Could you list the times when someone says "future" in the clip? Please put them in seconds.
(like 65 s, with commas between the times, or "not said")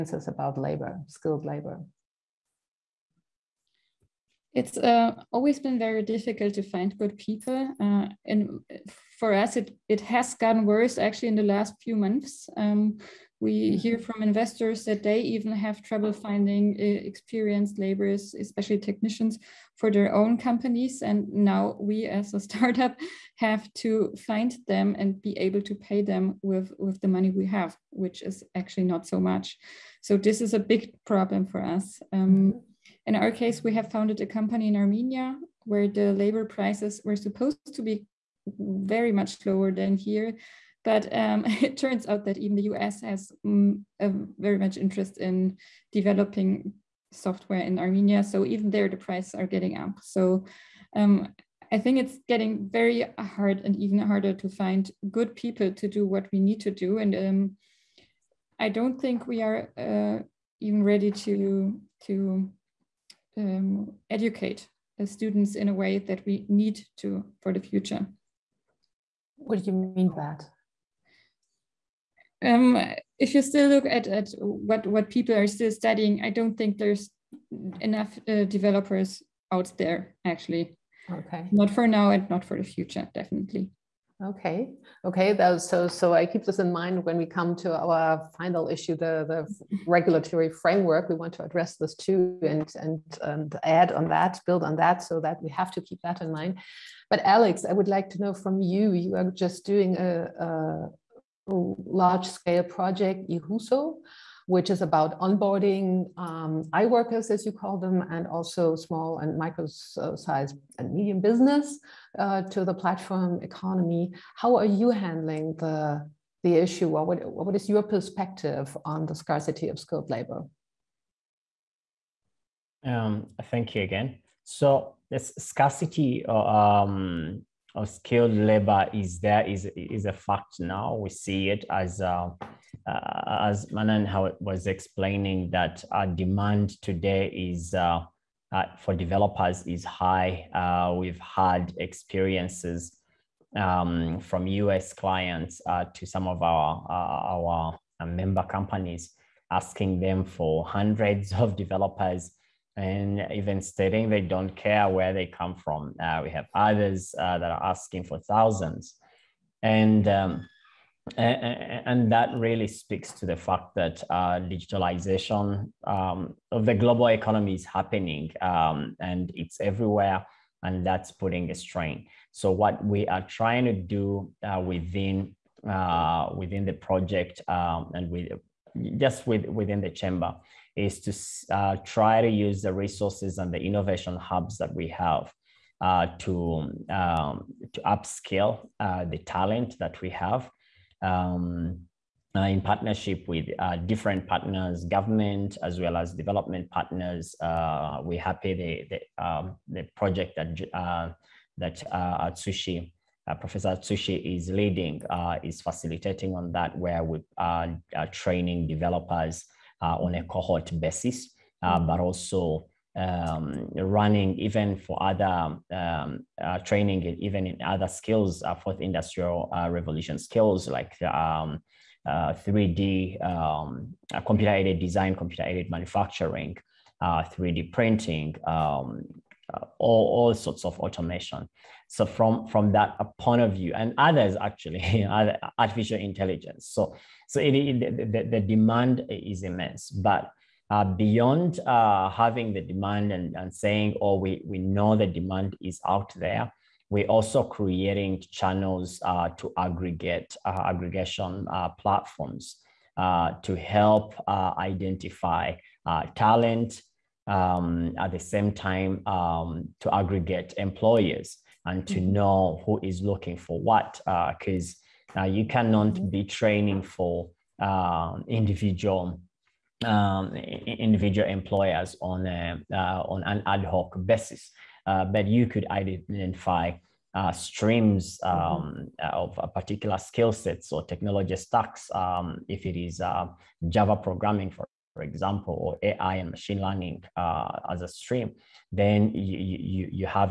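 67 s, 82 s.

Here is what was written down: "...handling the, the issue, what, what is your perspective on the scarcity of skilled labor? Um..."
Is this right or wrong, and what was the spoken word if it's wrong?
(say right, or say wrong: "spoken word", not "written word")
right.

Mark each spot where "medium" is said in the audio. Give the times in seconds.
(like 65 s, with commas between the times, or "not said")
110 s.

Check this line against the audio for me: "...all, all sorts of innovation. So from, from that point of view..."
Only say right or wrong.
wrong.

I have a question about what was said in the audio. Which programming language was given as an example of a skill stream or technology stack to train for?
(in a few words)
Java.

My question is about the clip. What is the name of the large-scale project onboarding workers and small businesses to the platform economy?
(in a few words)
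Ihuso.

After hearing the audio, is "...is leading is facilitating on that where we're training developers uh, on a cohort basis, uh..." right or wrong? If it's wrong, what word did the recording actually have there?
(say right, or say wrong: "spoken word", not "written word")
right.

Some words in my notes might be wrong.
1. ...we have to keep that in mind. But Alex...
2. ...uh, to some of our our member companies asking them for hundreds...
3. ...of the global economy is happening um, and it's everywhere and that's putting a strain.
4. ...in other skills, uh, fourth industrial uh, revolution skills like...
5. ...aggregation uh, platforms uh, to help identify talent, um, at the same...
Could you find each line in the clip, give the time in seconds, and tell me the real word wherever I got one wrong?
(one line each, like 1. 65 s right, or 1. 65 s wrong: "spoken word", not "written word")
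1. 95 s right
2. 145 s right
3. 166 s right
4. 217 s right
5. 250 s right.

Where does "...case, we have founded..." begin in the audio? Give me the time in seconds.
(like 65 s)
33 s.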